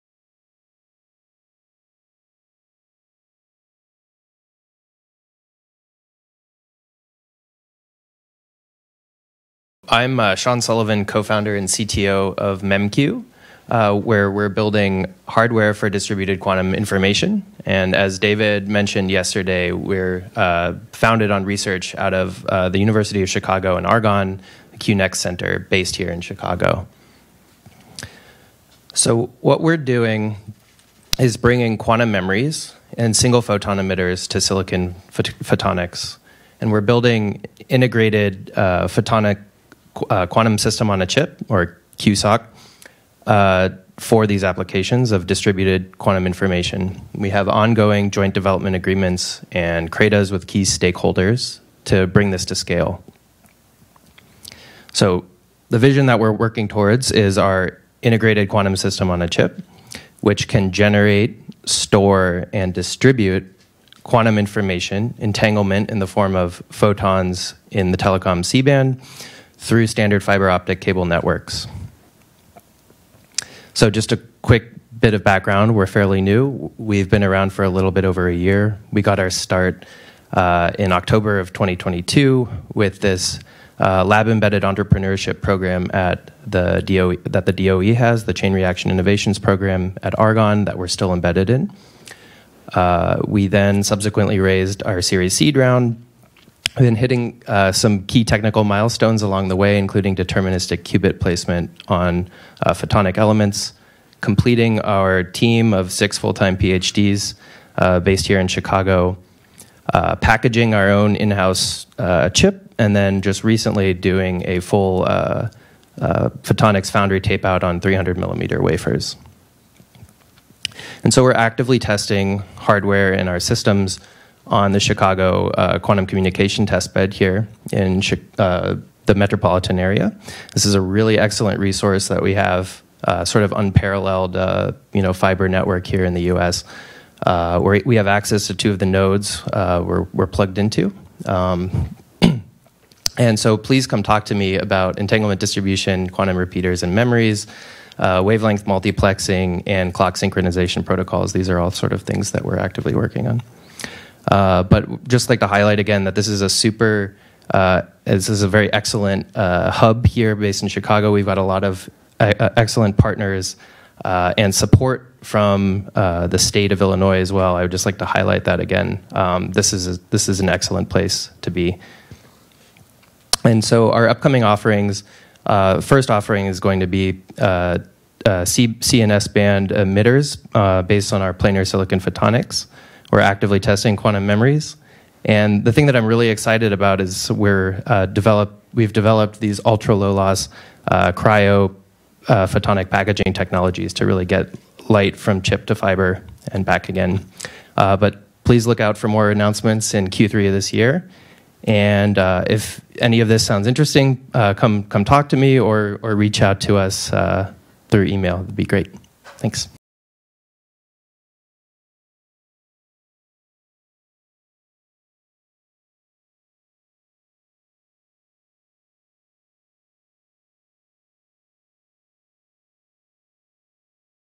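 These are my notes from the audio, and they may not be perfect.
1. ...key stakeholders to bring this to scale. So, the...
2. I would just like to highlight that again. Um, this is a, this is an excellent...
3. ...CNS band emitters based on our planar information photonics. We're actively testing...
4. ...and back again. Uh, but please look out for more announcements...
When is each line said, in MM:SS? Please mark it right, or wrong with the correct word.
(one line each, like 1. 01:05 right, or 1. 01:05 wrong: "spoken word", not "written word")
1. 00:50 right
2. 02:47 right
3. 02:58 wrong: "silicon", not "information"
4. 03:16 right.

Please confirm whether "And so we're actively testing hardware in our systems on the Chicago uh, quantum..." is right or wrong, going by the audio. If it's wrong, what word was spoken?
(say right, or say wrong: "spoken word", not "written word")
right.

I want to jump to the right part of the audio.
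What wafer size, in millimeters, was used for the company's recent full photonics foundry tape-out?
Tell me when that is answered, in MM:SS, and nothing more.
01:57.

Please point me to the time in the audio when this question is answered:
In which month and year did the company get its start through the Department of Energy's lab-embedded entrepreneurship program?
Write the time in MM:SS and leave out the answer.
01:20.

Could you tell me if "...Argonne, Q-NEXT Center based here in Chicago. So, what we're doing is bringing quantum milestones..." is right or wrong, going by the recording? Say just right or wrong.
wrong.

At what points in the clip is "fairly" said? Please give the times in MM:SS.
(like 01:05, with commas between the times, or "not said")
01:15.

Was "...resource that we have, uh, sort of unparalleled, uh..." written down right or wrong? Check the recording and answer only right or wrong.
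right.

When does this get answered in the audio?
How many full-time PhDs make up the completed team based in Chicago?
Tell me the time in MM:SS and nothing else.
01:45.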